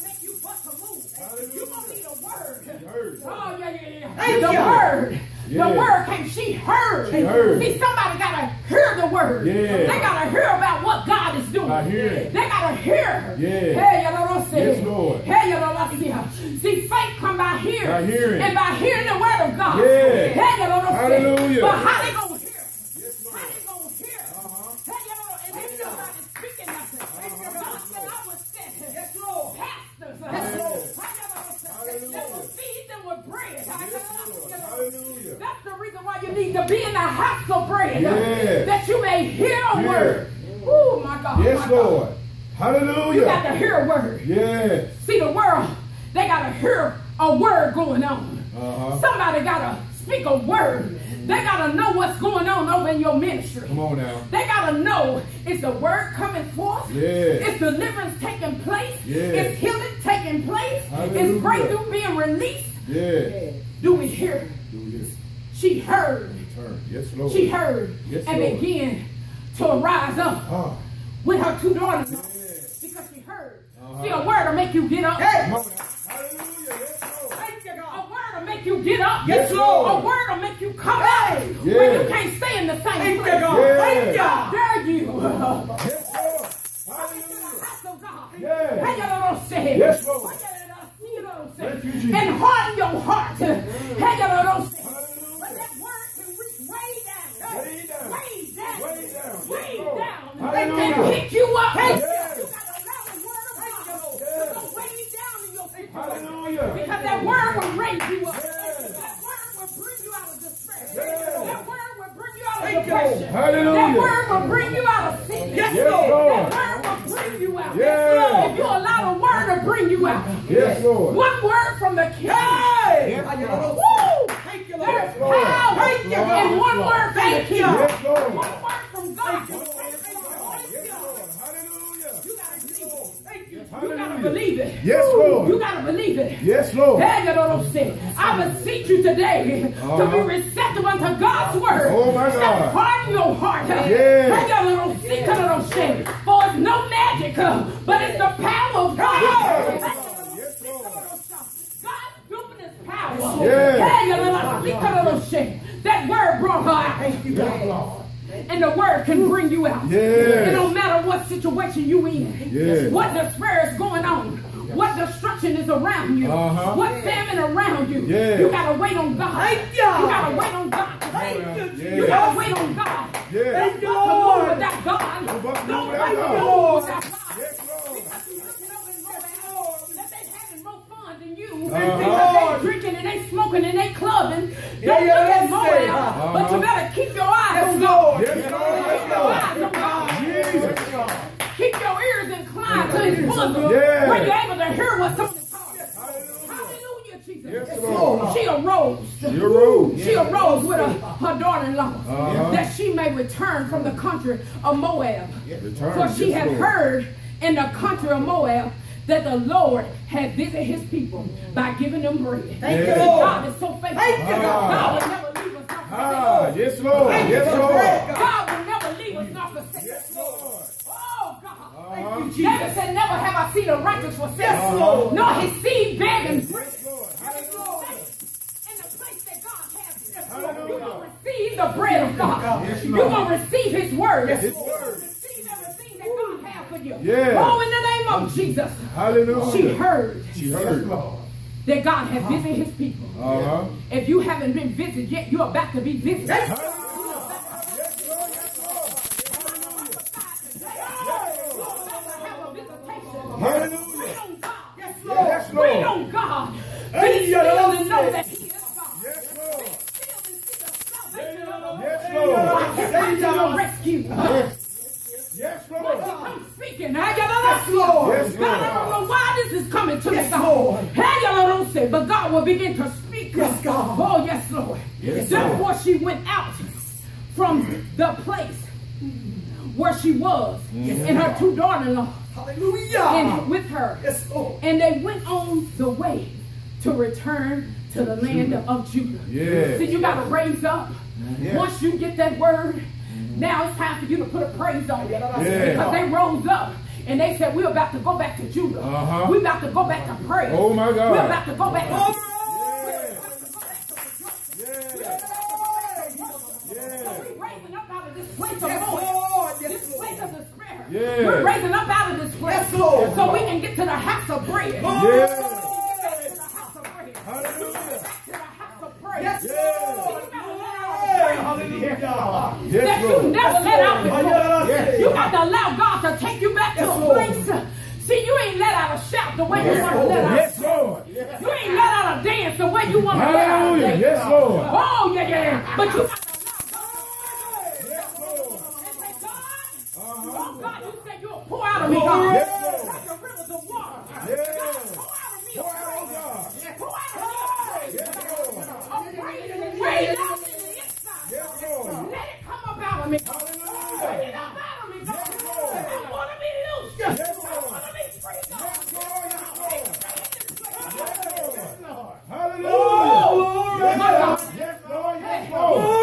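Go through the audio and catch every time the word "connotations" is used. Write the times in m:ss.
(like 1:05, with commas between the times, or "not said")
not said.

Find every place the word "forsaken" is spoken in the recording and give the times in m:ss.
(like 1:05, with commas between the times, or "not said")
3:39, 3:44.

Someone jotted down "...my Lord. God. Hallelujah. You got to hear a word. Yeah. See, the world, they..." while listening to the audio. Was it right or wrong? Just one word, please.
right.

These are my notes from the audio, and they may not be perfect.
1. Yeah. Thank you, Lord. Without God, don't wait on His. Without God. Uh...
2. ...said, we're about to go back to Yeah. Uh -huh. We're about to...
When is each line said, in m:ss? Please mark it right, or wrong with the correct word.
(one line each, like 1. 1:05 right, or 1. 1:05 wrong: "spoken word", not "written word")
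1. 2:53 wrong: "Lord", not "His"
2. 4:57 wrong: "Judah", not "Yeah".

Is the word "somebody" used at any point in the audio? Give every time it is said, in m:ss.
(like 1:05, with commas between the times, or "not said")
0:07, 0:49.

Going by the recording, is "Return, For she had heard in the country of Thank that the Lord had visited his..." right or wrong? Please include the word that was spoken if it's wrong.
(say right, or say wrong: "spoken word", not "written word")
wrong: "Moab", not "Thank".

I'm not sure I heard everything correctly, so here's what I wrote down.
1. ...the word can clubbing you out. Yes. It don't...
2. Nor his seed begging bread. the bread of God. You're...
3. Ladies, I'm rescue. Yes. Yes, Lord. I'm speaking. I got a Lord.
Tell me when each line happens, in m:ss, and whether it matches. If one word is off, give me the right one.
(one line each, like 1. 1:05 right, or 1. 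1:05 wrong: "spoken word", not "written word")
1. 2:38 wrong: "bring", not "clubbing"
2. 3:45 right
3. 4:23 right.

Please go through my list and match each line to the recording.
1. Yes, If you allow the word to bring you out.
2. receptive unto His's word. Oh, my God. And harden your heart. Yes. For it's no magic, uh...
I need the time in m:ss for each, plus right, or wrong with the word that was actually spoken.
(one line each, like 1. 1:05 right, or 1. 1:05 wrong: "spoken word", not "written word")
1. 1:57 right
2. 2:20 wrong: "God", not "His".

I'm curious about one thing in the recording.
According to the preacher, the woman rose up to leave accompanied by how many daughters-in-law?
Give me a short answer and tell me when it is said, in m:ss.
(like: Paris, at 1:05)
2, at 1:11.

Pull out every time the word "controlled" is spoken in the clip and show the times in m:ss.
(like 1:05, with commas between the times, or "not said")
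not said.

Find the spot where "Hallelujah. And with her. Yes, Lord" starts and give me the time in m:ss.
4:42.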